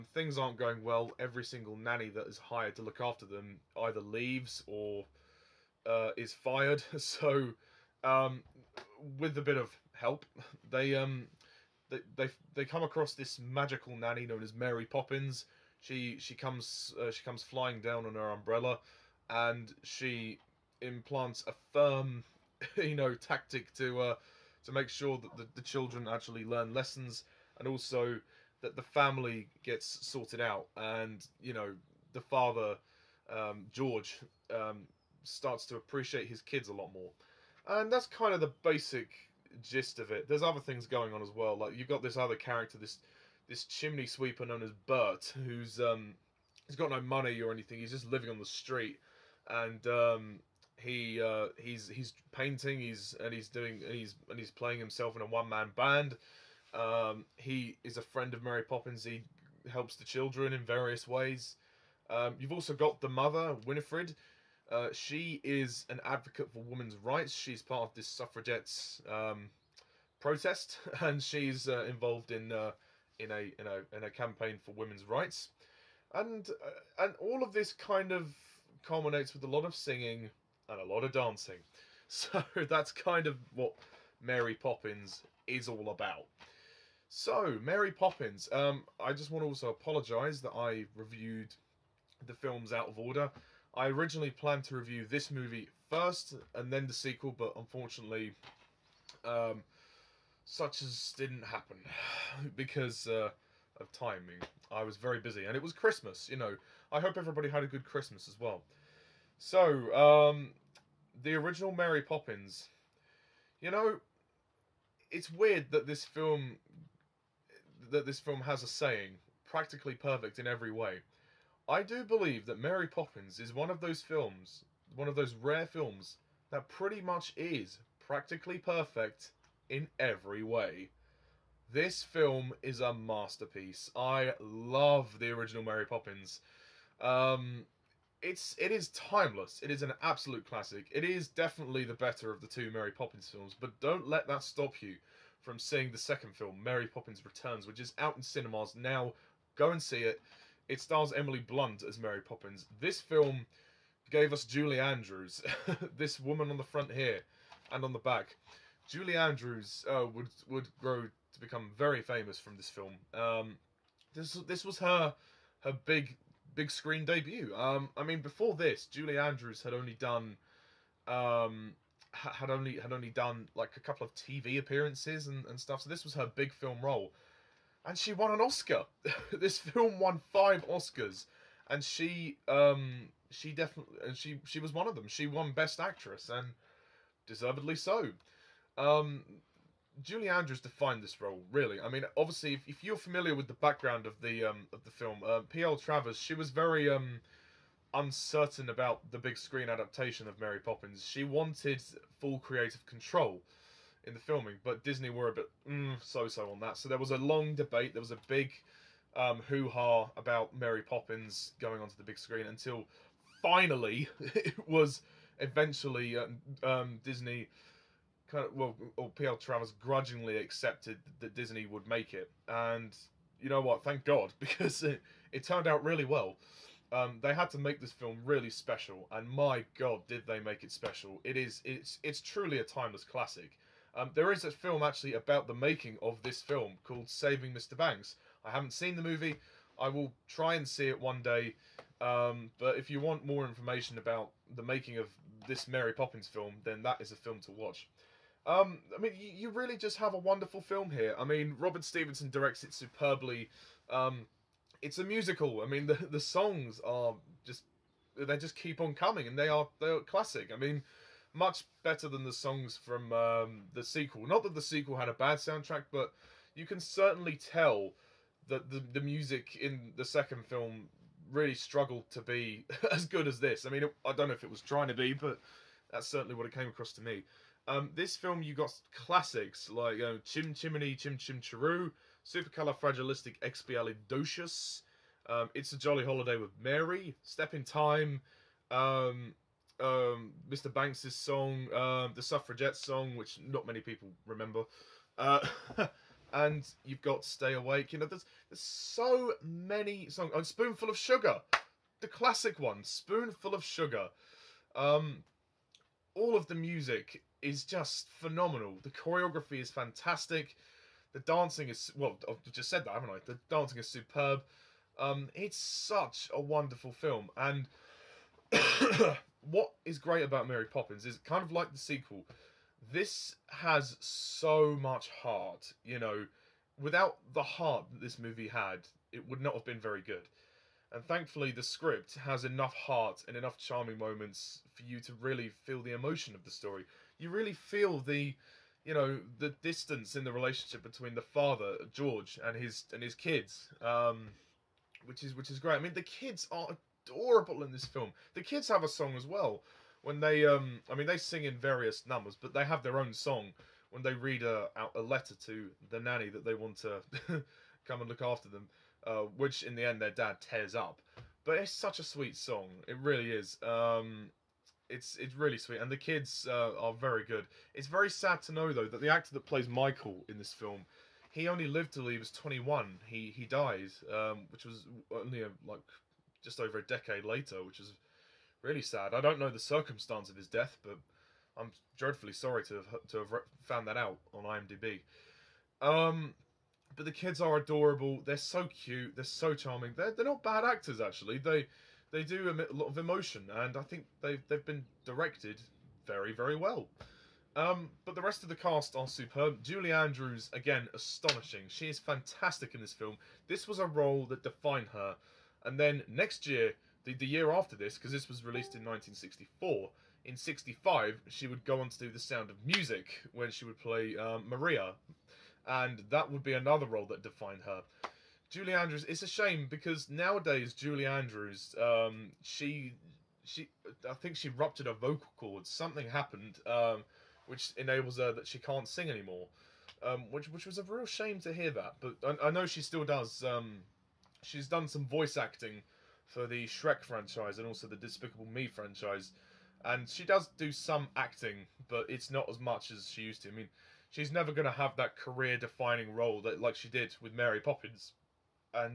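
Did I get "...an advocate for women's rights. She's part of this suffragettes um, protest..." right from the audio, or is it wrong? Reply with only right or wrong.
right.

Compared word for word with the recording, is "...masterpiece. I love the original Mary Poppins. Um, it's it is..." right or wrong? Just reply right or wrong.
right.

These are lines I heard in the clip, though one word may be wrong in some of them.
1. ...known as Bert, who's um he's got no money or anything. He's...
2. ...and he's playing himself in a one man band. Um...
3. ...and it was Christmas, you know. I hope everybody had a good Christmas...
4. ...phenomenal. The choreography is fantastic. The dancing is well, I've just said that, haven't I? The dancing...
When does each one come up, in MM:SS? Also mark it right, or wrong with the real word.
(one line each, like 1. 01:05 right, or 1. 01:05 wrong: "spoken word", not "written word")
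1. 00:44 right
2. 00:54 right
3. 01:45 right
4. 05:08 right.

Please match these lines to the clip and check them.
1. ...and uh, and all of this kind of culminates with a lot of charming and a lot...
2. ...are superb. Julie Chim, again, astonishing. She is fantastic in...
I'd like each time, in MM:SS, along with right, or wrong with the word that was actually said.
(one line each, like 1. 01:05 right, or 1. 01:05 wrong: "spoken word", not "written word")
1. 01:16 wrong: "singing", not "charming"
2. 06:38 wrong: "Andrews", not "Chim".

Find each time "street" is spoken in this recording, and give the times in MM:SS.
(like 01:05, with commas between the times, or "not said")
00:48.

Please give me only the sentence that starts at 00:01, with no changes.
Every single nanny that is hired to look after them either leaves or uh, is fired.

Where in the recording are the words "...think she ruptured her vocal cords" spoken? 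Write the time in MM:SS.
07:04.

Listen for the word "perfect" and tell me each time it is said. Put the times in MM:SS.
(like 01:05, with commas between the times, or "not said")
01:59, 02:08.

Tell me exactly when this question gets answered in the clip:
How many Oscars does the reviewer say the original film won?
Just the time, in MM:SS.
03:00.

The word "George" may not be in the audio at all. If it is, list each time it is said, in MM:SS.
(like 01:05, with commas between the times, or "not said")
00:33, 05:41.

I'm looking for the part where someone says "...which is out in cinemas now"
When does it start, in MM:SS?
02:27.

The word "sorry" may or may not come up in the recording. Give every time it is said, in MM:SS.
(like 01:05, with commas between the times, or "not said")
06:22.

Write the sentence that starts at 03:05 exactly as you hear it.
She won Best Actress and deservedly so.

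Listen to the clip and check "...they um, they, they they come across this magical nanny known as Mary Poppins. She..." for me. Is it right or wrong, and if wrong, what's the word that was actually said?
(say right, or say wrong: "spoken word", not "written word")
right.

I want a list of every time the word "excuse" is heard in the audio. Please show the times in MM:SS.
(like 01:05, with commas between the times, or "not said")
not said.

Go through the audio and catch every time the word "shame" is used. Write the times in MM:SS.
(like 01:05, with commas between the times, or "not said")
06:59, 07:11.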